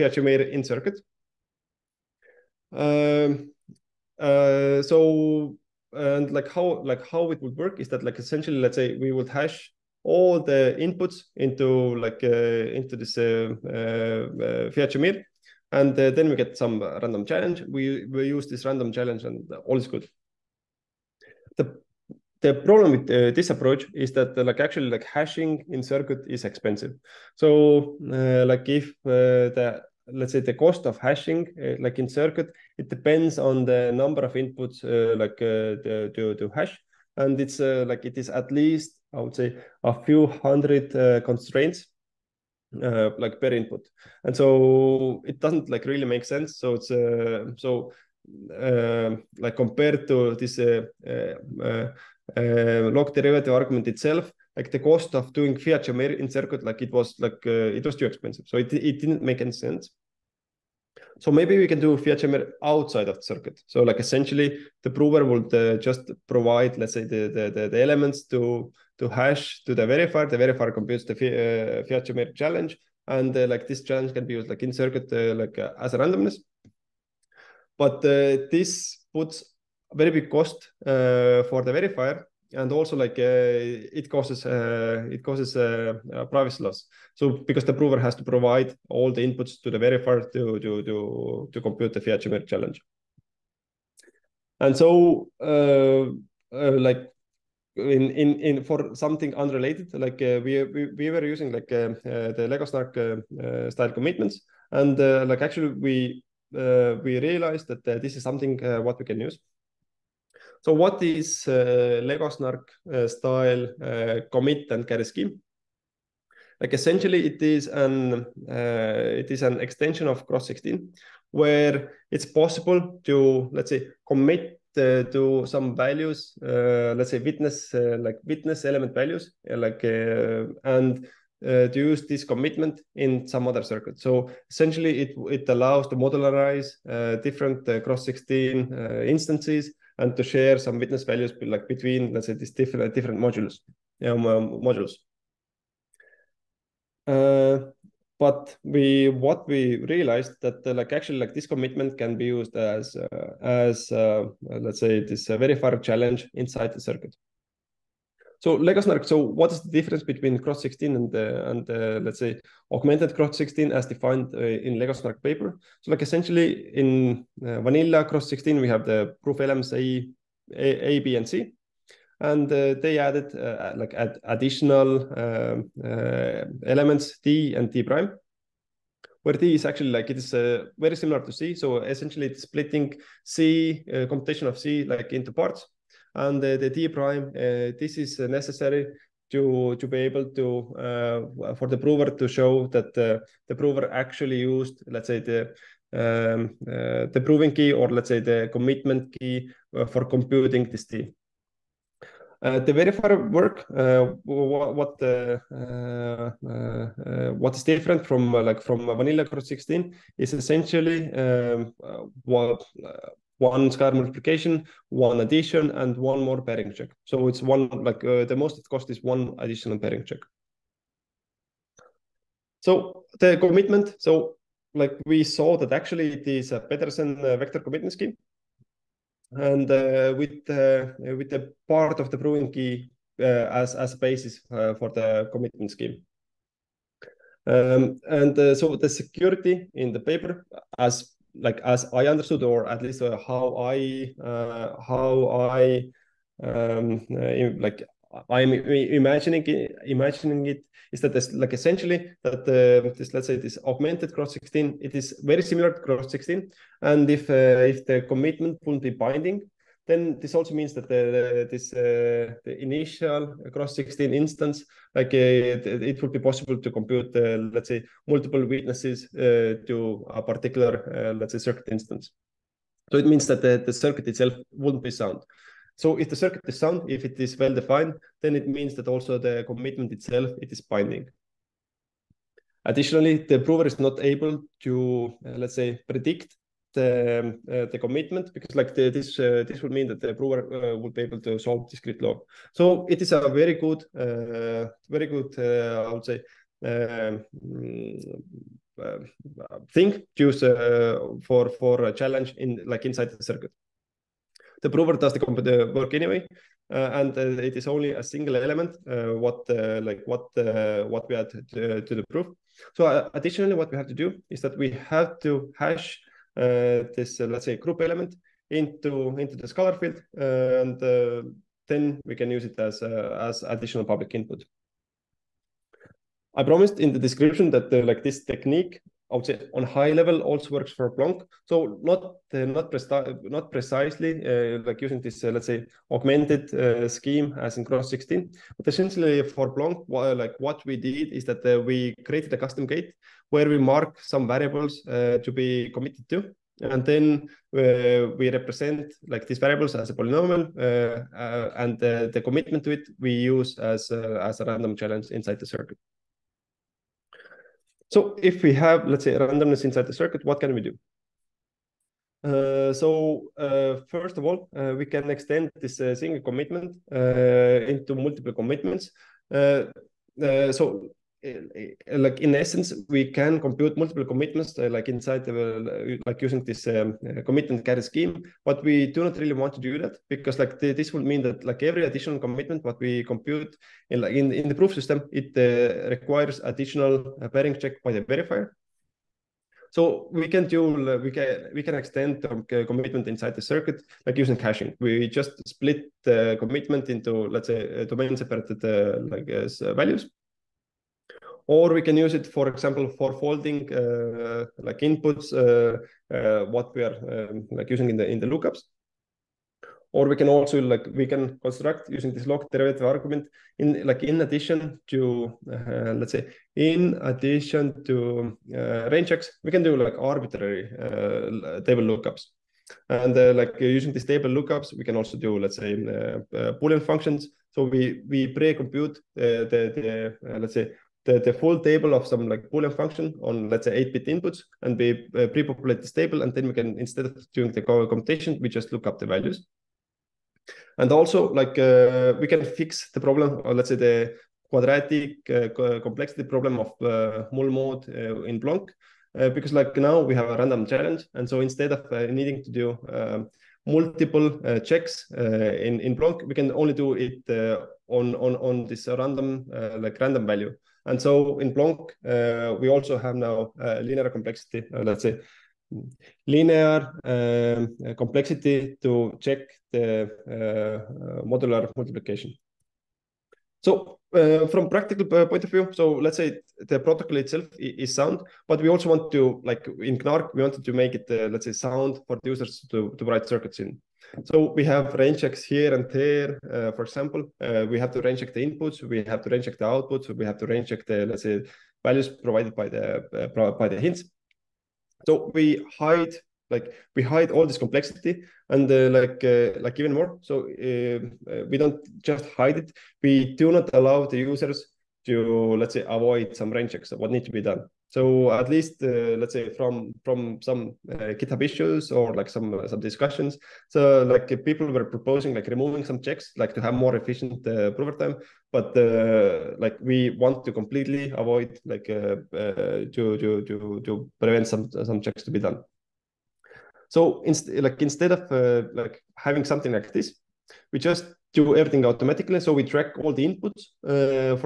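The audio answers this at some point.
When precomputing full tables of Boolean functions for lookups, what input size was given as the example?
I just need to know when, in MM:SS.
07:13.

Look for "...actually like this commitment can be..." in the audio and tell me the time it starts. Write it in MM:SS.
02:30.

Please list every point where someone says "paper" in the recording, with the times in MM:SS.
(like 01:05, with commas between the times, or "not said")
02:45, 03:59.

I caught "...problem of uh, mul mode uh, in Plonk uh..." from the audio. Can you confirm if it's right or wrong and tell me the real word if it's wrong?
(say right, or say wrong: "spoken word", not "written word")
right.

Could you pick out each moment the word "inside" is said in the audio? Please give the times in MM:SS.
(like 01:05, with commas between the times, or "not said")
02:36, 05:02, 05:55, 05:59, 06:14, 06:33.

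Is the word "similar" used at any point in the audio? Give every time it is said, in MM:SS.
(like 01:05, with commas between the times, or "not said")
03:00, 04:15.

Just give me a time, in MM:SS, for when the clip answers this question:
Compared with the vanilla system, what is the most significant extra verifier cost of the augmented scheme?
03:39.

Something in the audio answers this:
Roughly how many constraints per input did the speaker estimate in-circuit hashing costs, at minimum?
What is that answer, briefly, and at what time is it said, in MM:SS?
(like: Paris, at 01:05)
a few hundred, at 00:39.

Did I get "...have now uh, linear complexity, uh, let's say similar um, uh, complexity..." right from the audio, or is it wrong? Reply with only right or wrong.
wrong.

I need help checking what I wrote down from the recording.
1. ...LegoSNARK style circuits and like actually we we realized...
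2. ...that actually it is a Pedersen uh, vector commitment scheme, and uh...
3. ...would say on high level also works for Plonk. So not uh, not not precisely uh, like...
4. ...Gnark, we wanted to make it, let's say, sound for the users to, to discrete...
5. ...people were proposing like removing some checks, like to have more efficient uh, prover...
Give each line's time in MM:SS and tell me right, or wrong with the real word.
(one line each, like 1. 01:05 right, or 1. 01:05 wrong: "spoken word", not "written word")
1. 01:42 wrong: "commitments", not "circuits"
2. 03:45 right
3. 05:29 right
4. 07:59 wrong: "write", not "discrete"
5. 08:34 right.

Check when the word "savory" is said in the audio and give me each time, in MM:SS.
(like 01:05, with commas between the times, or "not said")
not said.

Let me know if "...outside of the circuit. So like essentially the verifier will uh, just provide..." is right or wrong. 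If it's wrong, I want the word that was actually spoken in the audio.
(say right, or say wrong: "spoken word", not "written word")
wrong: "prover", not "verifier".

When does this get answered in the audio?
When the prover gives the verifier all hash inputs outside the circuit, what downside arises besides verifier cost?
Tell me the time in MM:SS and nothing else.
01:26.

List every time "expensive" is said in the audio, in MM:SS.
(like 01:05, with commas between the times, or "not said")
00:26, 00:58.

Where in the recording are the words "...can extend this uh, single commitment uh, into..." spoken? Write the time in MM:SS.
06:04.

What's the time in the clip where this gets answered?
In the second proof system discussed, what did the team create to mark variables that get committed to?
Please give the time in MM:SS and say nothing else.
05:42.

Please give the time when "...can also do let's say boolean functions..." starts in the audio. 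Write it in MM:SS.
07:04.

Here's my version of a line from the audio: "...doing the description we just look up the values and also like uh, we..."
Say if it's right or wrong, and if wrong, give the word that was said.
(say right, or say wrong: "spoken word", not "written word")
wrong: "computation", not "description".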